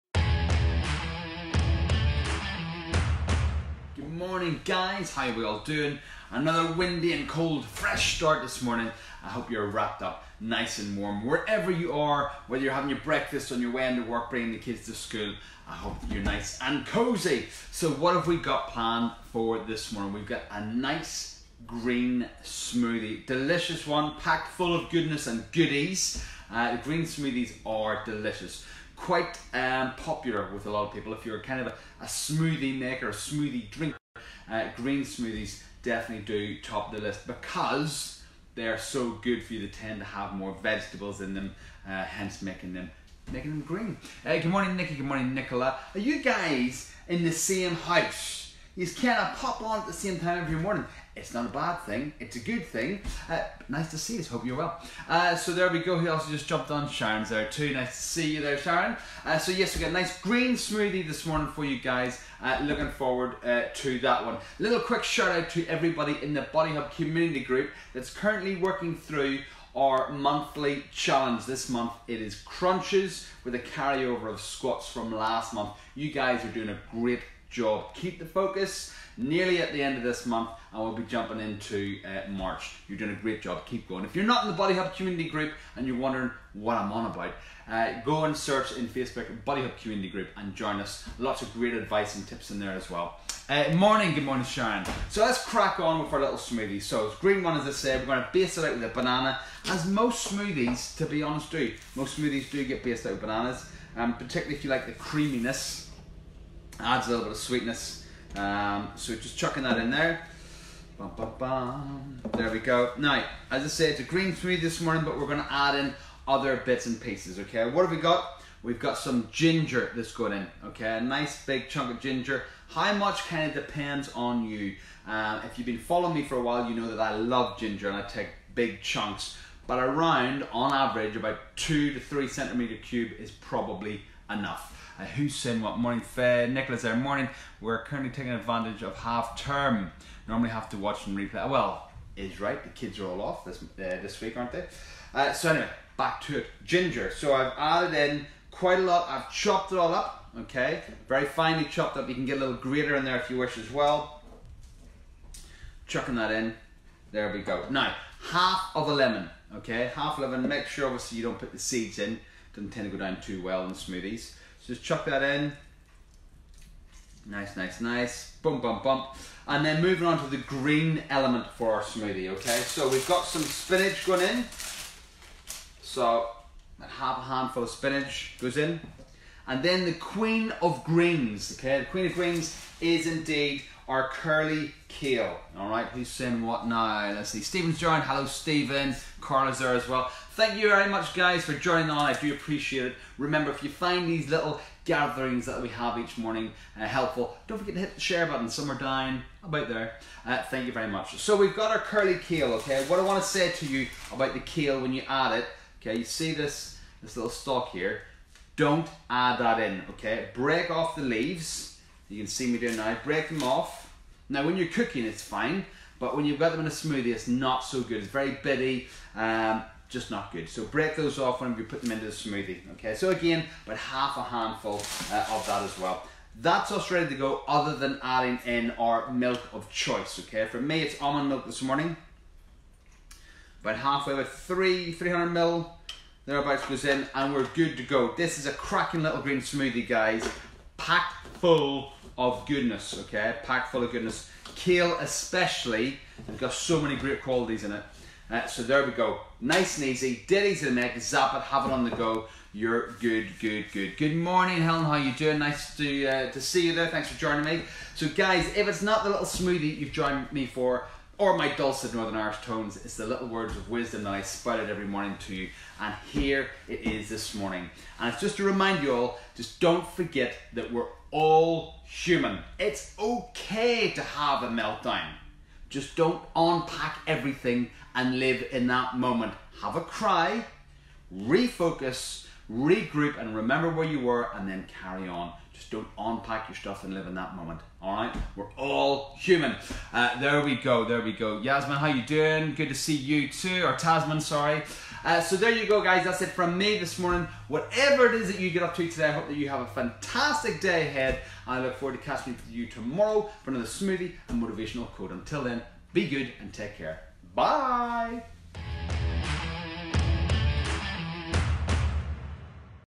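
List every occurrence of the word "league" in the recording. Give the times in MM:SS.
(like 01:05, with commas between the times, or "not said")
not said.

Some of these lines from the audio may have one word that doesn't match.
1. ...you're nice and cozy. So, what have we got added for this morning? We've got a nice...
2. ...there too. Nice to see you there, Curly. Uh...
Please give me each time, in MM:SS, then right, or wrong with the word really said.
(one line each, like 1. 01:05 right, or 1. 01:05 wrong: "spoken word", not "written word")
1. 00:16 wrong: "planned", not "added"
2. 00:57 wrong: "Sharon", not "Curly".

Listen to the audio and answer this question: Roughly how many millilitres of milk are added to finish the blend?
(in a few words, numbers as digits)
300.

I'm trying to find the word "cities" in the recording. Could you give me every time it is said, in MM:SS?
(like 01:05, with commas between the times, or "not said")
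not said.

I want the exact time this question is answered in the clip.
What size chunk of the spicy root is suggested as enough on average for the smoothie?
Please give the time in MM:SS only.
02:11.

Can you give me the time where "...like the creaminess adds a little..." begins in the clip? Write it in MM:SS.
01:44.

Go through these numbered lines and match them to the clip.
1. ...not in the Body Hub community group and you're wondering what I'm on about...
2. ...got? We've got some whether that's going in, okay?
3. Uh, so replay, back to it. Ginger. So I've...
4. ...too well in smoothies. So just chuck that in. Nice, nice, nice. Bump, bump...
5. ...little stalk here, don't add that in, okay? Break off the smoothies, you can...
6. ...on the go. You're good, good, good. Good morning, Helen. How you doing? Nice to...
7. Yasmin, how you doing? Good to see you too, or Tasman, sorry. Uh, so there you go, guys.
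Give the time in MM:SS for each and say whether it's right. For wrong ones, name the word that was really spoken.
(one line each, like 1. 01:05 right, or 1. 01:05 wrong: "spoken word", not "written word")
1. 01:24 right
2. 01:58 wrong: "ginger", not "whether"
3. 02:25 wrong: "anyway", not "replay"
4. 02:43 right
5. 03:27 wrong: "leaves", not "smoothies"
6. 04:11 right
7. 04:51 right.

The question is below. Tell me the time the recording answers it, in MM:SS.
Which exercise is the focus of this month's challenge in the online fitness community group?
01:12.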